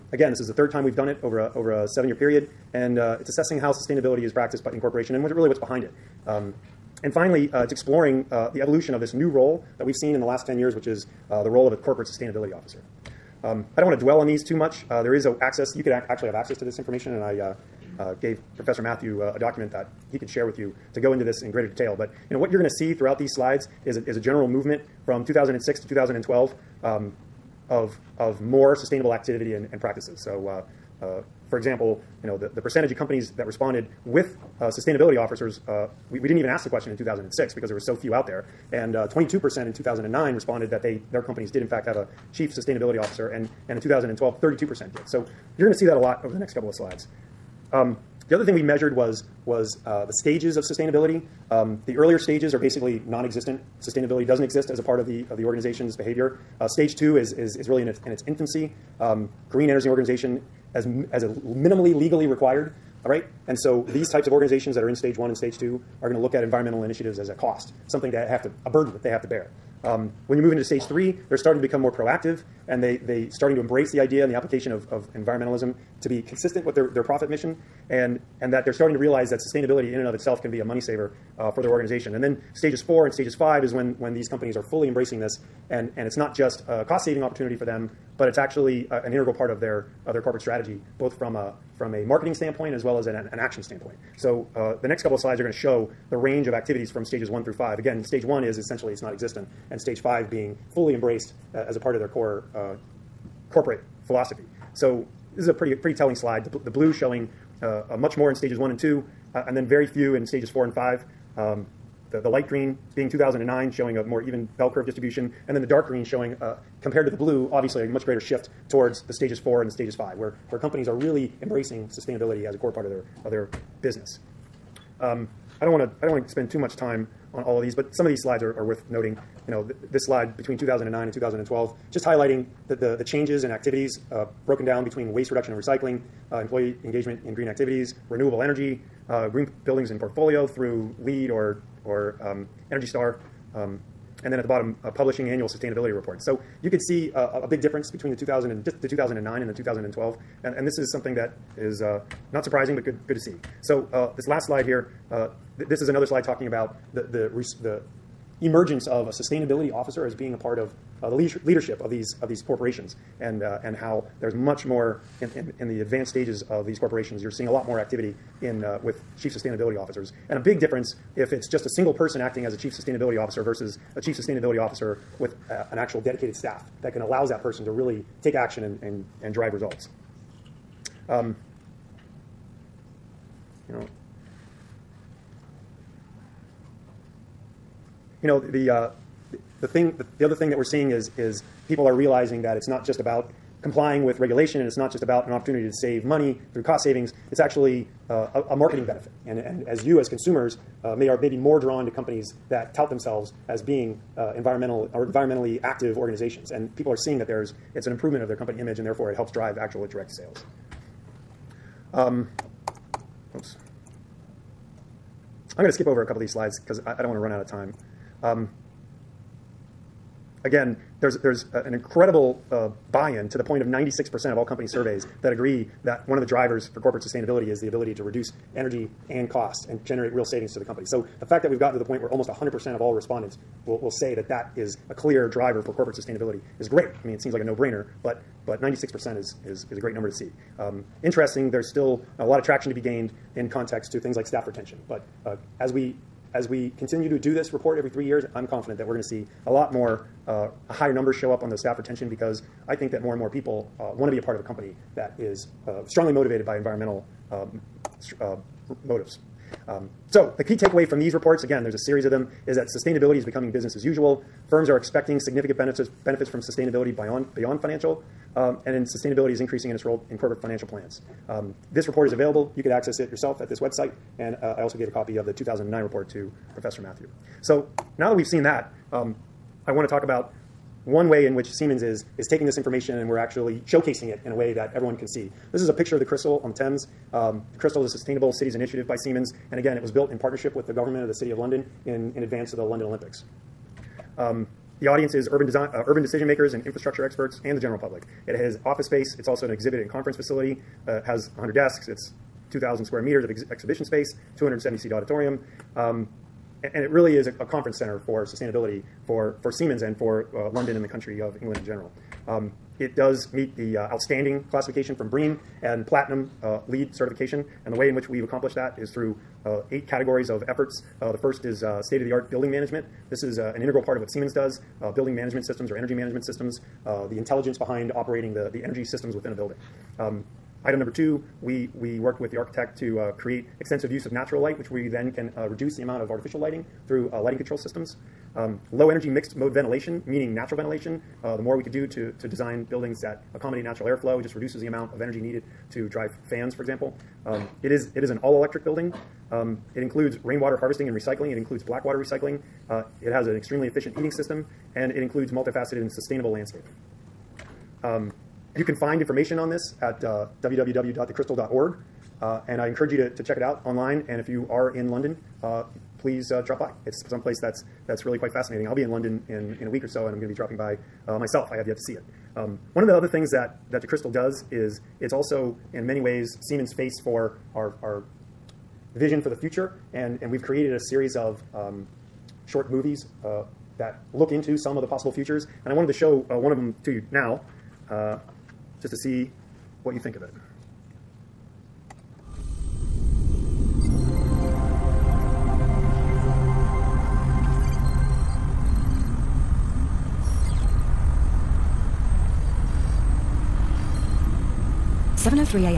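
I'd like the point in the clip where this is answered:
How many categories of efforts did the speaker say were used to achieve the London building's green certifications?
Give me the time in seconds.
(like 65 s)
319 s.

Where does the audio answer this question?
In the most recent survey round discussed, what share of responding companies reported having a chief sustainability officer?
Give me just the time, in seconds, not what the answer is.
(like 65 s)
44 s.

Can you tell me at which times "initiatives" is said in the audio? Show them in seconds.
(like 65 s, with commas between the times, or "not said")
66 s, 288 s.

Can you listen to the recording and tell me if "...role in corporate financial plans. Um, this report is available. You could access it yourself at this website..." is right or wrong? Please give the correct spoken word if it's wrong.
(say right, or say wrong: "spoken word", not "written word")
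right.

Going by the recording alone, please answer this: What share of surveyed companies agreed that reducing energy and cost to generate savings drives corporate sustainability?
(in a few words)
96%.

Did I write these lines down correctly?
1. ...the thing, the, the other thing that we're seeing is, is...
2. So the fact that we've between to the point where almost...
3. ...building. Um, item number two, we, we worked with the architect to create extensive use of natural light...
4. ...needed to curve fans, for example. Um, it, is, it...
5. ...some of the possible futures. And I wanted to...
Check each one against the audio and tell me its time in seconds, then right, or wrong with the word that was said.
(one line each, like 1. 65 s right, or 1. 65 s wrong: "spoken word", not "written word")
1. 189 s right
2. 230 s wrong: "gotten", not "between"
3. 329 s right
4. 345 s wrong: "drive", not "curve"
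5. 384 s right.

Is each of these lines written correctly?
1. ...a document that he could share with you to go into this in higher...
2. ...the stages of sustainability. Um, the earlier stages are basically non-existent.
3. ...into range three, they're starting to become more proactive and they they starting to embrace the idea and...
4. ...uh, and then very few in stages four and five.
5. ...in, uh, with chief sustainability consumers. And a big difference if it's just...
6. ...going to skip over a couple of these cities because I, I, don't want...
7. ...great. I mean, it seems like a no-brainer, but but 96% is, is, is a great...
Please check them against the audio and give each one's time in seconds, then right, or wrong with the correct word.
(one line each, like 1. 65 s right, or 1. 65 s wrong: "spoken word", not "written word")
1. 19 s wrong: "greater", not "higher"
2. 50 s right
3. 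70 s wrong: "stage", not "range"
4. 109 s right
5. 168 s wrong: "officers", not "consumers"
6. 215 s wrong: "slides", not "cities"
7. 236 s right.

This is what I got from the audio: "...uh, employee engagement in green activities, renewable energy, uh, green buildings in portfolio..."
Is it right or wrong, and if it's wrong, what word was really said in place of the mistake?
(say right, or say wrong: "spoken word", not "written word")
right.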